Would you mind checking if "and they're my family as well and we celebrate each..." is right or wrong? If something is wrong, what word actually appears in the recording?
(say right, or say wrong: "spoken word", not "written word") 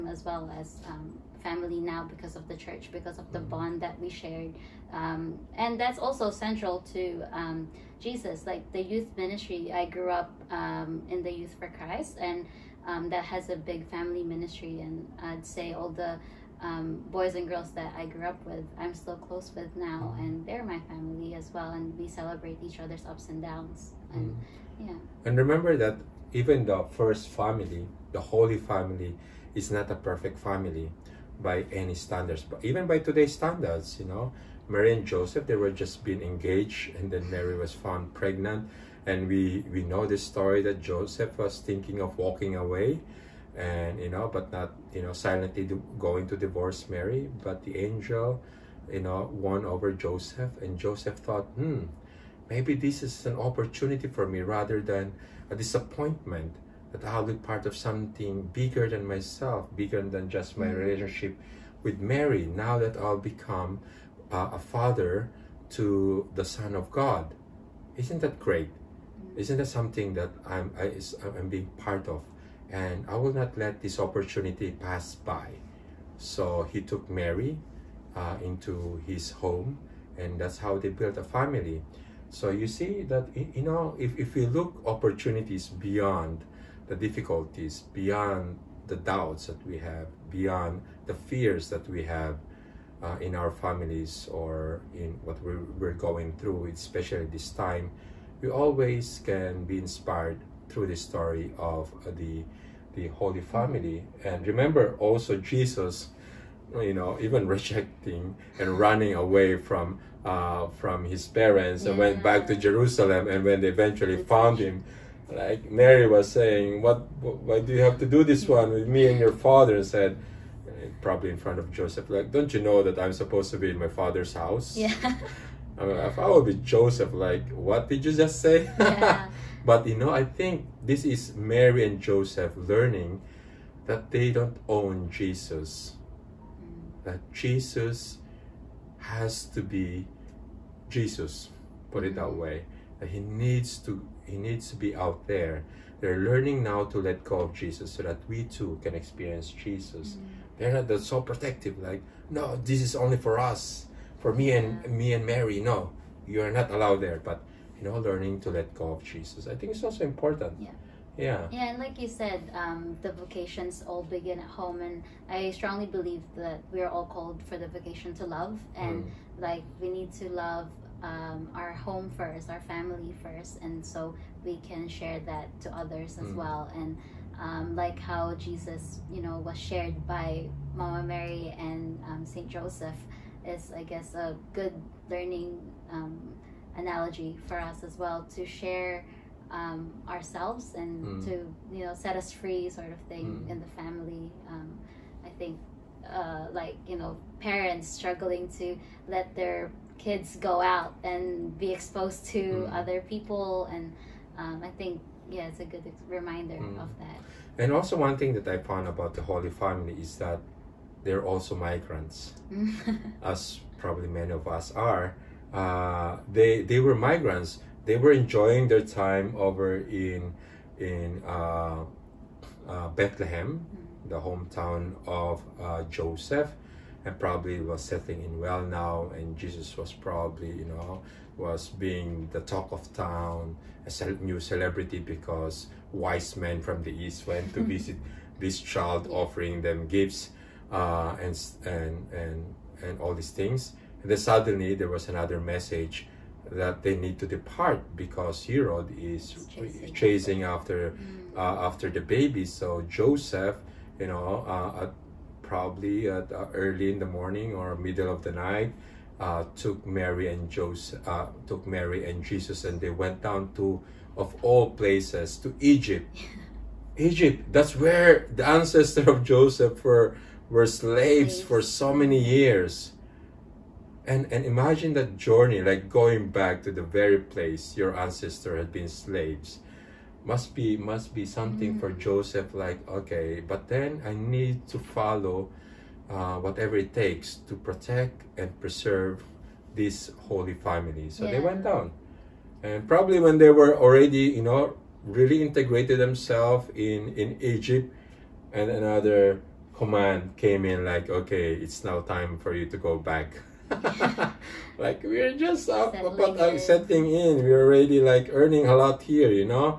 right.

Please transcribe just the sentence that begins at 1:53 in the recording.
And when they eventually found him, like Mary was saying, "What?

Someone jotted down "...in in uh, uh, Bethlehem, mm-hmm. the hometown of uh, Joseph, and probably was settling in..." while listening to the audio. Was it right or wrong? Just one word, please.
right.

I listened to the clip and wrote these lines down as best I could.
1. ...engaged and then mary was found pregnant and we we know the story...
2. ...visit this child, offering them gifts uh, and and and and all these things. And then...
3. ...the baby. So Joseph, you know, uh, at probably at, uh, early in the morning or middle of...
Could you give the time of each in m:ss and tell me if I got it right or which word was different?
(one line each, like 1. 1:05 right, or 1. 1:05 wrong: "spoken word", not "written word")
1. 0:36 right
2. 3:57 right
3. 4:11 right.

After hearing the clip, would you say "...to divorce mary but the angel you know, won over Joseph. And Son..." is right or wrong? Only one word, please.
wrong.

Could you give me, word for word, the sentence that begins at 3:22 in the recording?
other people and um, i think yeah it's a good reminder hmm.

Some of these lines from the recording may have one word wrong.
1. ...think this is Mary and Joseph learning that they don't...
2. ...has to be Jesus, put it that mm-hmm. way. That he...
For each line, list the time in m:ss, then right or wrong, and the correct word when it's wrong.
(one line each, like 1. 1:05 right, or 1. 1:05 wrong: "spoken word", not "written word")
1. 2:10 right
2. 2:18 right.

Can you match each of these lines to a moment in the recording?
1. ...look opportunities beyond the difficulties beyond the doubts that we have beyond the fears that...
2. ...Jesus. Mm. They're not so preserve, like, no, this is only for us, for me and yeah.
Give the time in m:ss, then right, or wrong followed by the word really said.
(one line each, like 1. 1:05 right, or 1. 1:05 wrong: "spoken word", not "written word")
1. 1:24 right
2. 2:29 wrong: "protective", not "preserve".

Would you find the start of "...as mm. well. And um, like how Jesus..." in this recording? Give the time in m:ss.
2:56.